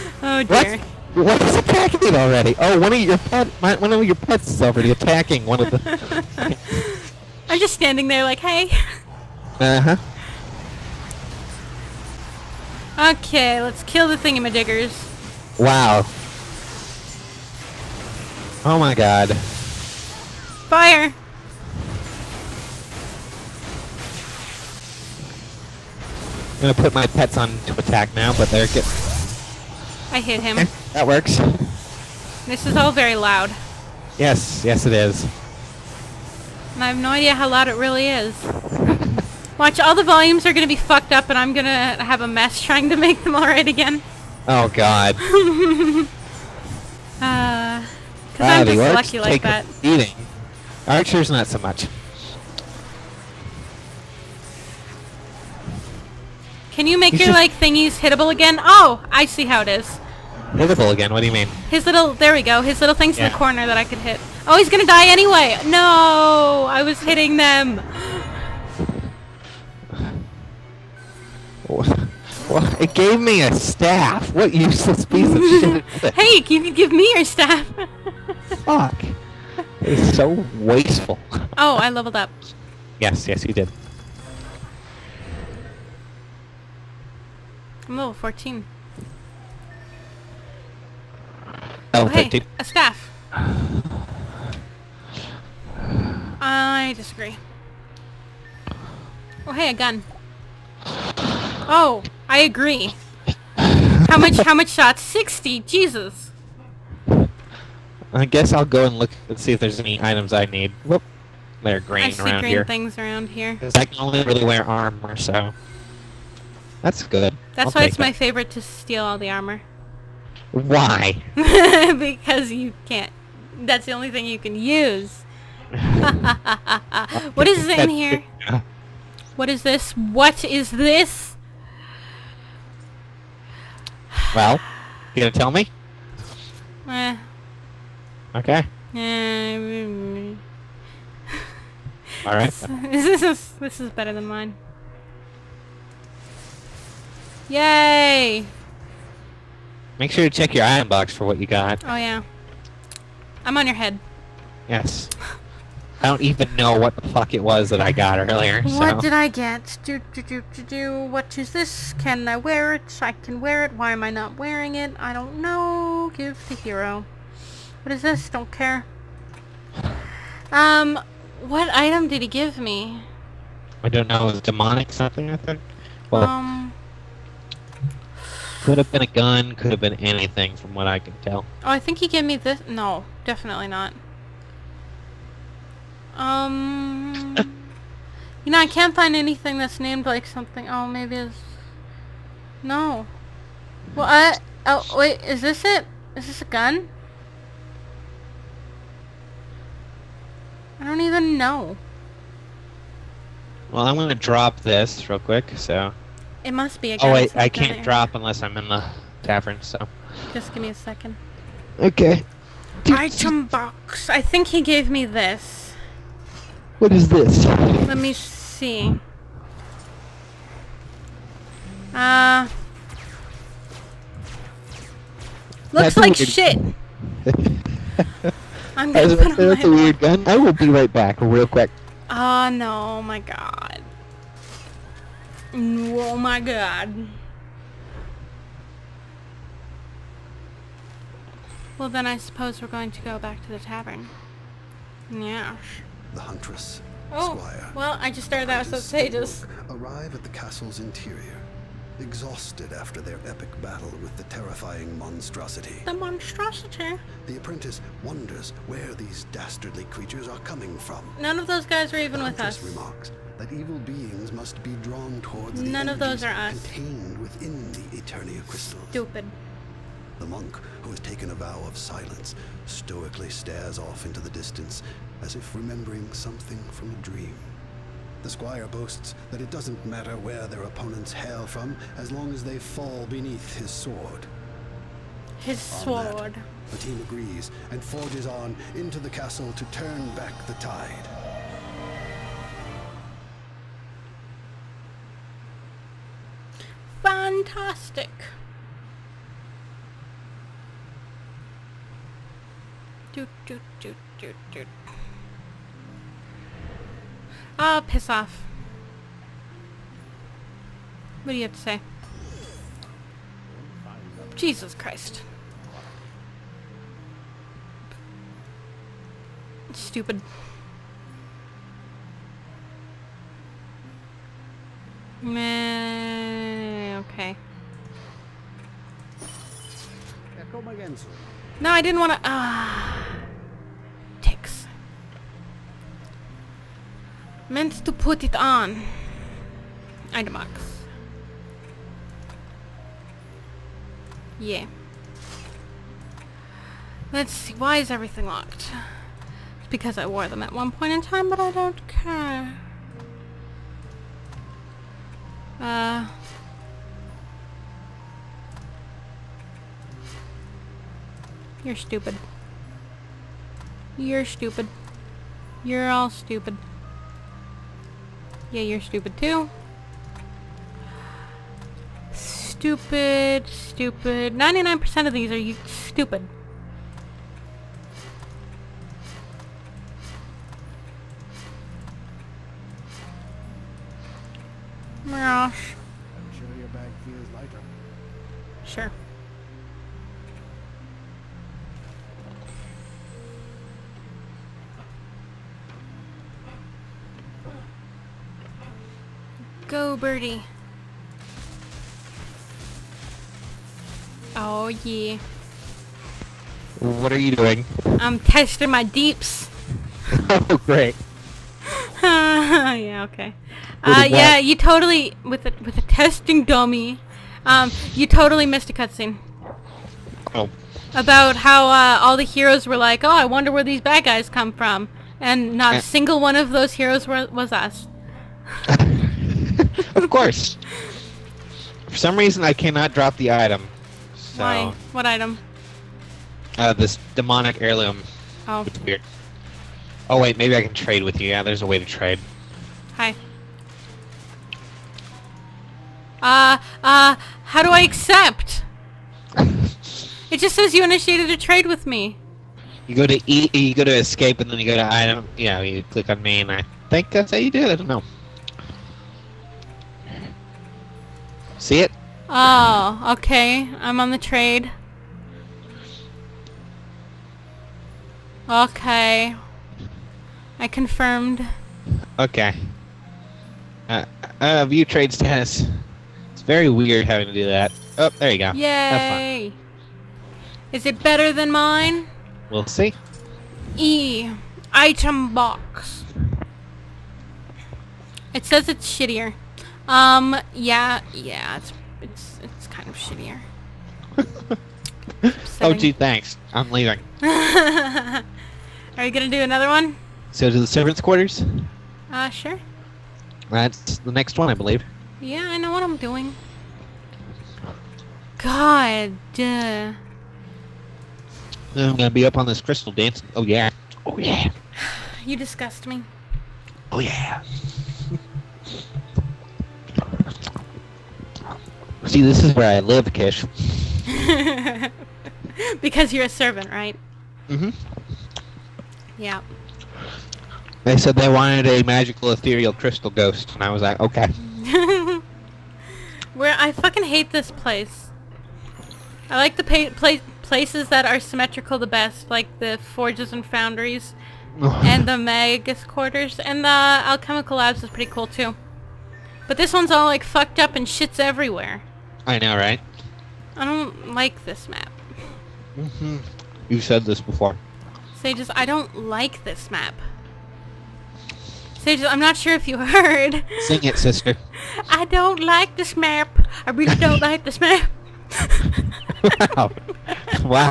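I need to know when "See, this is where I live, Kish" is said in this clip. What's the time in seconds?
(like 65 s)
522 s.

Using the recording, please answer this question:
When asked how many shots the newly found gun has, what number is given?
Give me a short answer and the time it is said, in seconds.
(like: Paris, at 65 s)
60, at 105 s.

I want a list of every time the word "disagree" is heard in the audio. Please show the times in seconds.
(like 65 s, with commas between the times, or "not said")
96 s.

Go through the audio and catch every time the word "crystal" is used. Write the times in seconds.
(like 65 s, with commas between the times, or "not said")
268 s, 512 s, 532 s.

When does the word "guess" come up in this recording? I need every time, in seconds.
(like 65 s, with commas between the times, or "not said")
108 s.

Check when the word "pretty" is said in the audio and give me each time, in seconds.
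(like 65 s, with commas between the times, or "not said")
547 s.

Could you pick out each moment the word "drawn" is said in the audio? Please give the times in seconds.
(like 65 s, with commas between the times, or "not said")
264 s.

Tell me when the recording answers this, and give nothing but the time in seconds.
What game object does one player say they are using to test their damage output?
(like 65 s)
415 s.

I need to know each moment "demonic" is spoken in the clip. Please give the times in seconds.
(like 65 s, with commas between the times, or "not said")
174 s, 437 s.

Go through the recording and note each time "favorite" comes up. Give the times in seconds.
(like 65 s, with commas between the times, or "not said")
118 s.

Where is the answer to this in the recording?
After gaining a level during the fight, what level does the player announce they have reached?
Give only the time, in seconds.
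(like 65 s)
87 s.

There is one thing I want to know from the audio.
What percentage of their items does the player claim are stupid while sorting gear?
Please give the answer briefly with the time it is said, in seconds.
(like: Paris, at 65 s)
99%, at 374 s.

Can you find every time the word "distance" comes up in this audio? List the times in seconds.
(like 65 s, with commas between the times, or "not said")
274 s.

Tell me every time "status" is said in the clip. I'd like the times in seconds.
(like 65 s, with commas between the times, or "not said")
248 s, 475 s.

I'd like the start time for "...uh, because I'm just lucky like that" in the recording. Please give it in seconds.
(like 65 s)
47 s.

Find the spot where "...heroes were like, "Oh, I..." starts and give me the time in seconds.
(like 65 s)
422 s.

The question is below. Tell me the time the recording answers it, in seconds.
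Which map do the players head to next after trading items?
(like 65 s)
500 s.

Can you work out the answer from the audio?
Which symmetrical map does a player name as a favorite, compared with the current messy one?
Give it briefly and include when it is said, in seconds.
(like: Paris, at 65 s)
The forges and foundries, at 542 s.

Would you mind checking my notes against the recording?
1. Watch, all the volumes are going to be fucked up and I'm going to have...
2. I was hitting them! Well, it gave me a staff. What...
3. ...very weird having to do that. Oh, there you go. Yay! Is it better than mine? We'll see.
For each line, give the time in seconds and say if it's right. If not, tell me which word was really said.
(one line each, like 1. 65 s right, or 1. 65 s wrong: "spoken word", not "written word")
1. 39 s right
2. 66 s right
3. 476 s right.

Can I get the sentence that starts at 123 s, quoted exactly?
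That's the only thing you can use.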